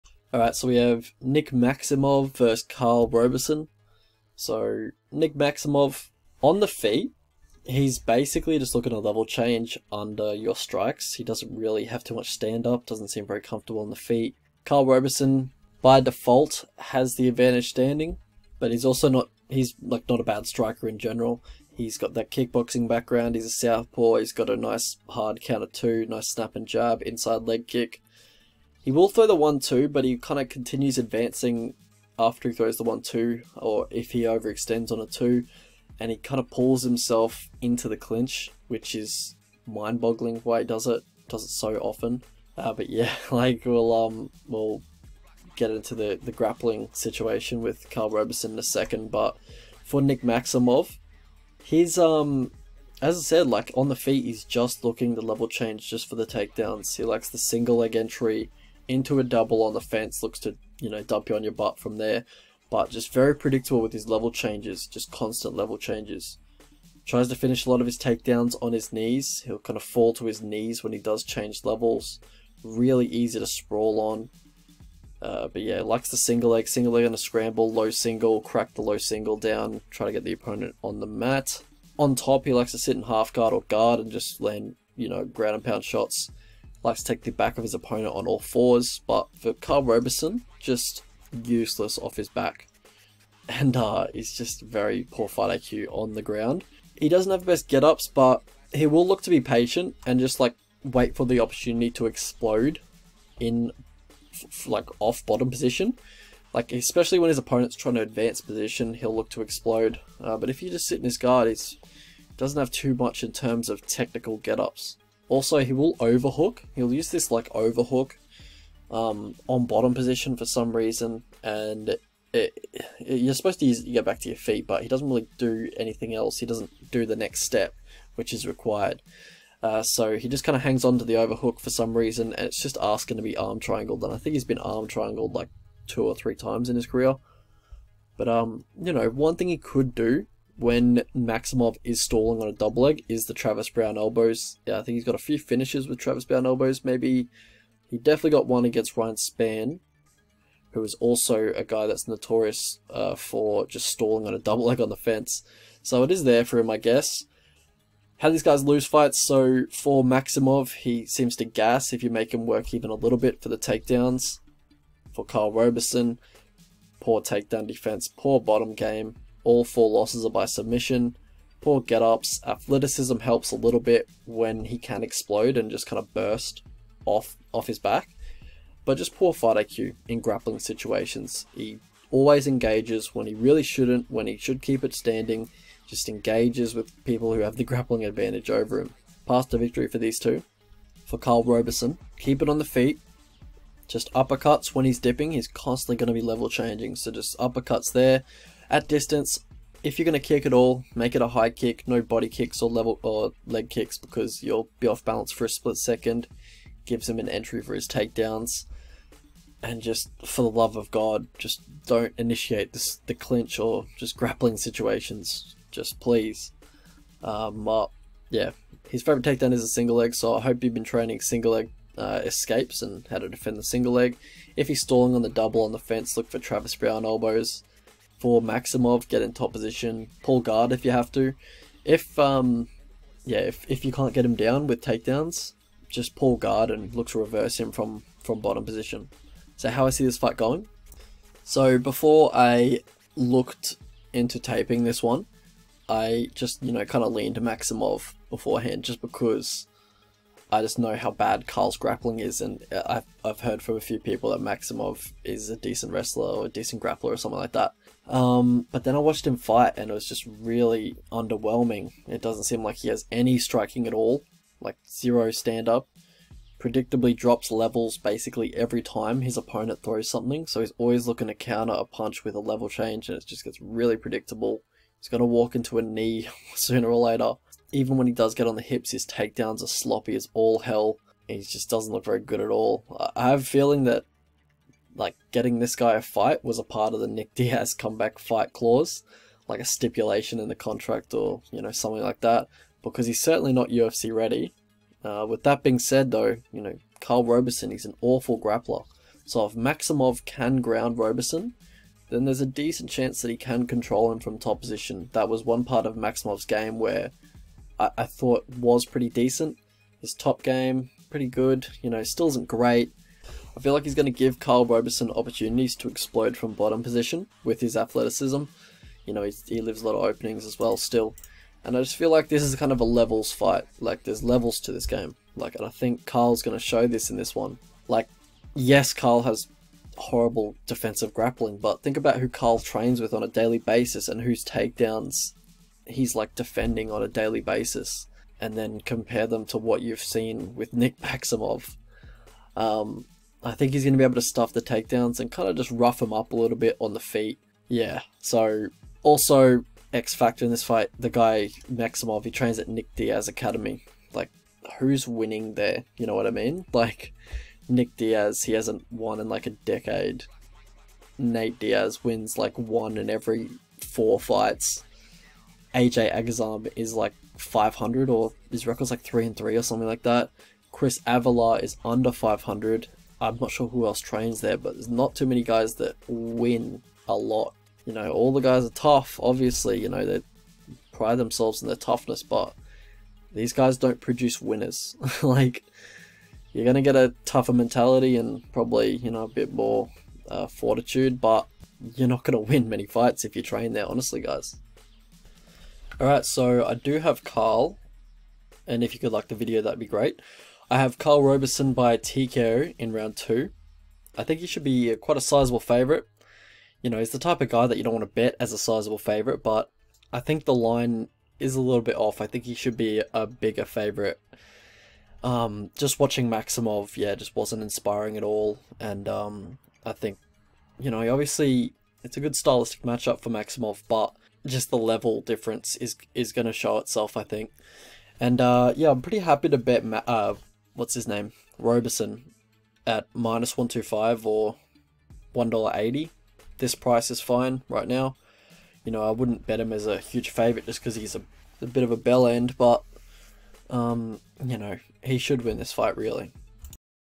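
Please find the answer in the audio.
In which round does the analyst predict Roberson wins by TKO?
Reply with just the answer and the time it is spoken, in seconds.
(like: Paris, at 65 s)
Round 2, at 402 s.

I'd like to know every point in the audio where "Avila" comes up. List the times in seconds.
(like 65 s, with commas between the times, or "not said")
371 s.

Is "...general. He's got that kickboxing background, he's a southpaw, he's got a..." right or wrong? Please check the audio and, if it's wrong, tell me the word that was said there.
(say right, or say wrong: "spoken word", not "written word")
right.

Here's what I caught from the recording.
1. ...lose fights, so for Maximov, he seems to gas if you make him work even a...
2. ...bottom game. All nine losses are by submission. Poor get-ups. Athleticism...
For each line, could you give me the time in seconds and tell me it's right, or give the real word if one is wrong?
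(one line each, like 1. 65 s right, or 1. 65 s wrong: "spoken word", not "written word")
1. 158 s right
2. 168 s wrong: "four", not "nine".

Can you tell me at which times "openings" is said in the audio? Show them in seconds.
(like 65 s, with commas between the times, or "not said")
320 s.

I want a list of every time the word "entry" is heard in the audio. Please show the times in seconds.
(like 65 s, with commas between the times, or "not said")
57 s, 207 s.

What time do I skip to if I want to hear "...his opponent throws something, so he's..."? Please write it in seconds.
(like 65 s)
269 s.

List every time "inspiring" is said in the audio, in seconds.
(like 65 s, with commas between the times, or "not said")
417 s.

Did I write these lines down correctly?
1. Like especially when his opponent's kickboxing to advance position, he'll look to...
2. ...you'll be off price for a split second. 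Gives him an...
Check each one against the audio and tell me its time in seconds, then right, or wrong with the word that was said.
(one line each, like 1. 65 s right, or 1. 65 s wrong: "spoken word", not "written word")
1. 106 s wrong: "trying", not "kickboxing"
2. 204 s wrong: "balance", not "price".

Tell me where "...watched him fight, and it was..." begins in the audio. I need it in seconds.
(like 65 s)
258 s.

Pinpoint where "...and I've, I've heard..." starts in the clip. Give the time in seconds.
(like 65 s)
252 s.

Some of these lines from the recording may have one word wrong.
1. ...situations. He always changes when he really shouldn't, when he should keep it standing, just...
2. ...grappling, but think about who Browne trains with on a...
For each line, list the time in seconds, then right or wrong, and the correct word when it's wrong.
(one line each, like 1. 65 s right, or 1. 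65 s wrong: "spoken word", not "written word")
1. 180 s wrong: "engages", not "changes"
2. 331 s wrong: "Karl", not "Browne".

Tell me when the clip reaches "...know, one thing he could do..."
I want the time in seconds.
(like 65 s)
138 s.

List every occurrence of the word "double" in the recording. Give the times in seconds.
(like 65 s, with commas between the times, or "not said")
59 s, 142 s, 154 s, 225 s.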